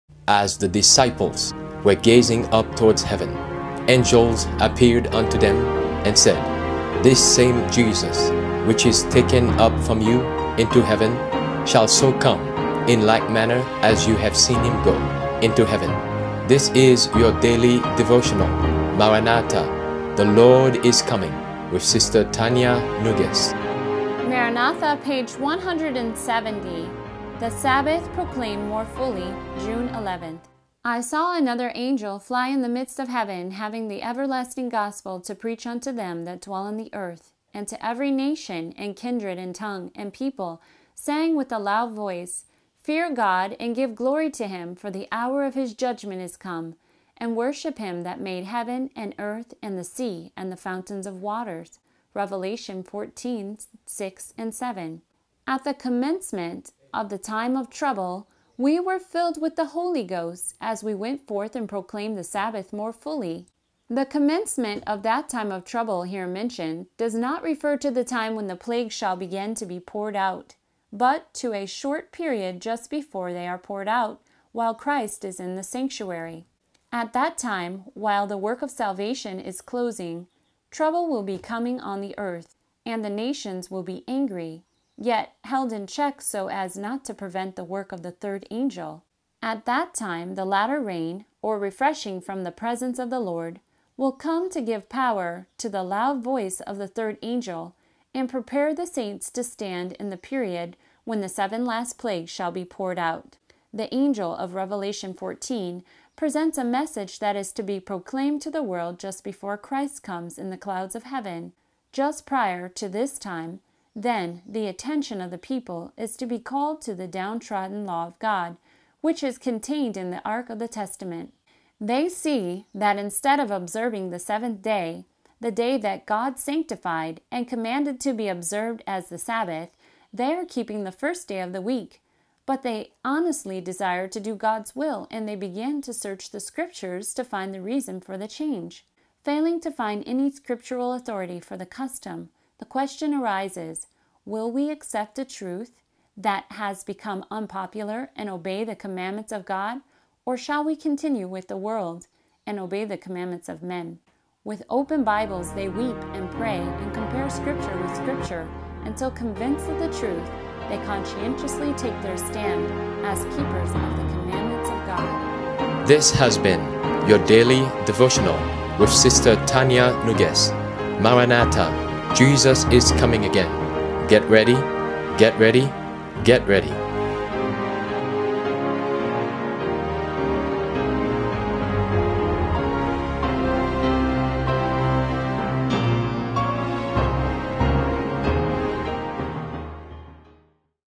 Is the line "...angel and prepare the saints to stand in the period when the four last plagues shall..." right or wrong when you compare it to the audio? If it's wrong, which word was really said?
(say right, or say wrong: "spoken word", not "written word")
wrong: "seven", not "four".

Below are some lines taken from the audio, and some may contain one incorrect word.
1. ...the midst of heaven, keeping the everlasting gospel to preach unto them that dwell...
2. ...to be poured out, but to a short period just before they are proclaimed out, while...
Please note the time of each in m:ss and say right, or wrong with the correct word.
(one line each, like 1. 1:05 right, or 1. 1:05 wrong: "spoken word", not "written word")
1. 0:32 wrong: "having", not "keeping"
2. 1:09 wrong: "poured", not "proclaimed".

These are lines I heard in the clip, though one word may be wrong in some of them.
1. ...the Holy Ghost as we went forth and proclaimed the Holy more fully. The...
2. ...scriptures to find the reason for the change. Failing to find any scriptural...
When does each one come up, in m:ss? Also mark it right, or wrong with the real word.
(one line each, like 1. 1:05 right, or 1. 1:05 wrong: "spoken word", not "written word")
1. 0:59 wrong: "Sabbath", not "Holy"
2. 2:16 right.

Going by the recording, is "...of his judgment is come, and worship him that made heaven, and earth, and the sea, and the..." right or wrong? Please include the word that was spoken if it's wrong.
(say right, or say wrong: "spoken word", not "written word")
right.